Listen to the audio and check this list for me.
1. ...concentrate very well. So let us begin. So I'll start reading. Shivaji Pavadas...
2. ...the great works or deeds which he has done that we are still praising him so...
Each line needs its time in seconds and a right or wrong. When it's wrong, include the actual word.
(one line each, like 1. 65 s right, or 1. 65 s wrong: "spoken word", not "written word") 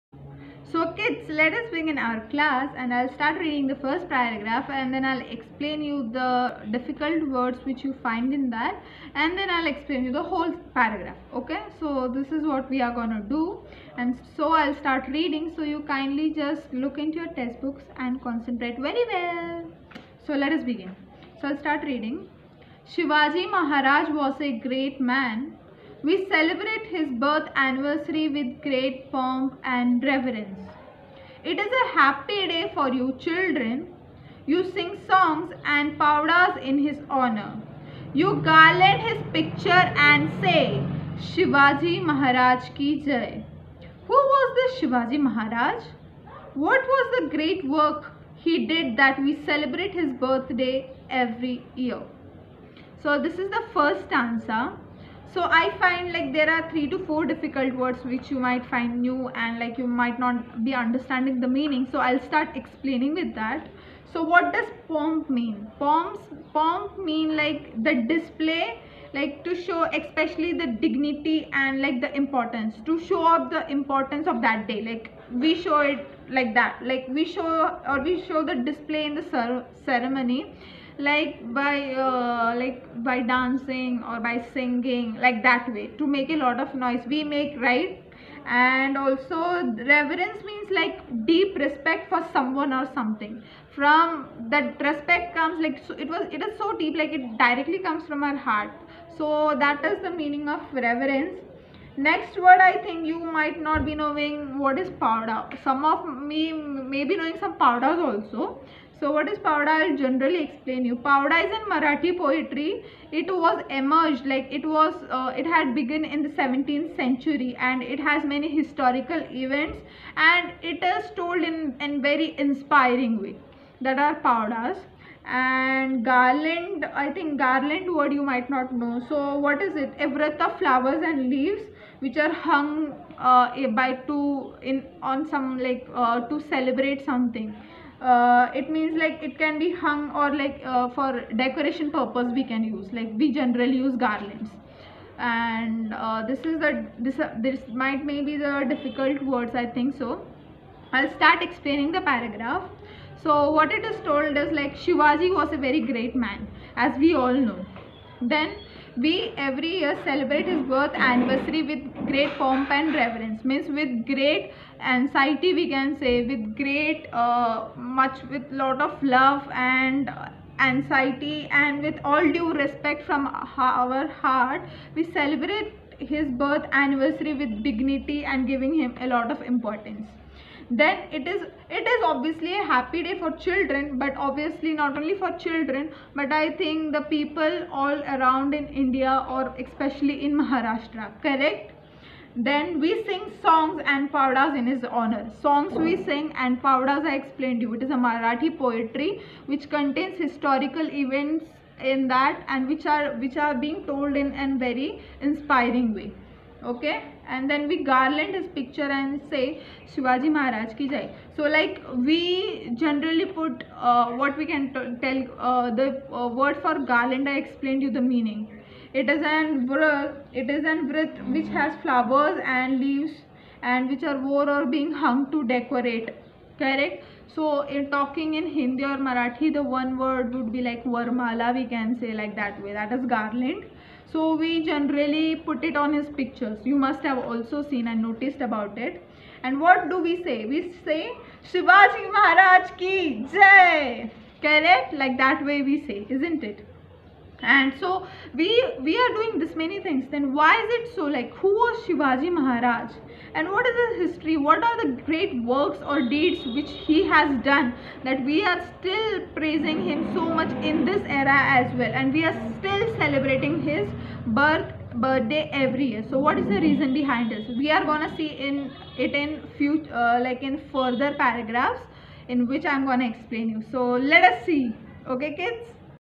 1. 18 s wrong: "Maharaj", not "Pavadas"
2. 254 s right.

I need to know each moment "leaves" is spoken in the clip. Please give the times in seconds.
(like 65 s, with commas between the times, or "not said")
131 s, 222 s.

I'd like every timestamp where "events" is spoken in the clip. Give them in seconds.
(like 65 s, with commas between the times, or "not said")
119 s, 201 s.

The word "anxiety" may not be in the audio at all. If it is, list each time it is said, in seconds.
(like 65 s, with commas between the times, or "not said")
164 s, 170 s.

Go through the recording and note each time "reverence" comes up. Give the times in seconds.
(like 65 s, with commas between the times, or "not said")
30 s, 89 s, 100 s, 162 s.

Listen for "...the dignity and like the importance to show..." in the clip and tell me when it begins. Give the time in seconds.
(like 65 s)
70 s.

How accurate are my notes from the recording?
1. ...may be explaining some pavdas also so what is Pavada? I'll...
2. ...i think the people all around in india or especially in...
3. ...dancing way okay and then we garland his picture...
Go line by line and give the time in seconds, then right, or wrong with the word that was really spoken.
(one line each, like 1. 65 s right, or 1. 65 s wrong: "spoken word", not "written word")
1. 106 s wrong: "knowing", not "explaining"
2. 186 s right
3. 205 s wrong: "inspiring", not "dancing".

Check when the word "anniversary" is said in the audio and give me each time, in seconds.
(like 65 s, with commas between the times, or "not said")
27 s, 160 s, 176 s.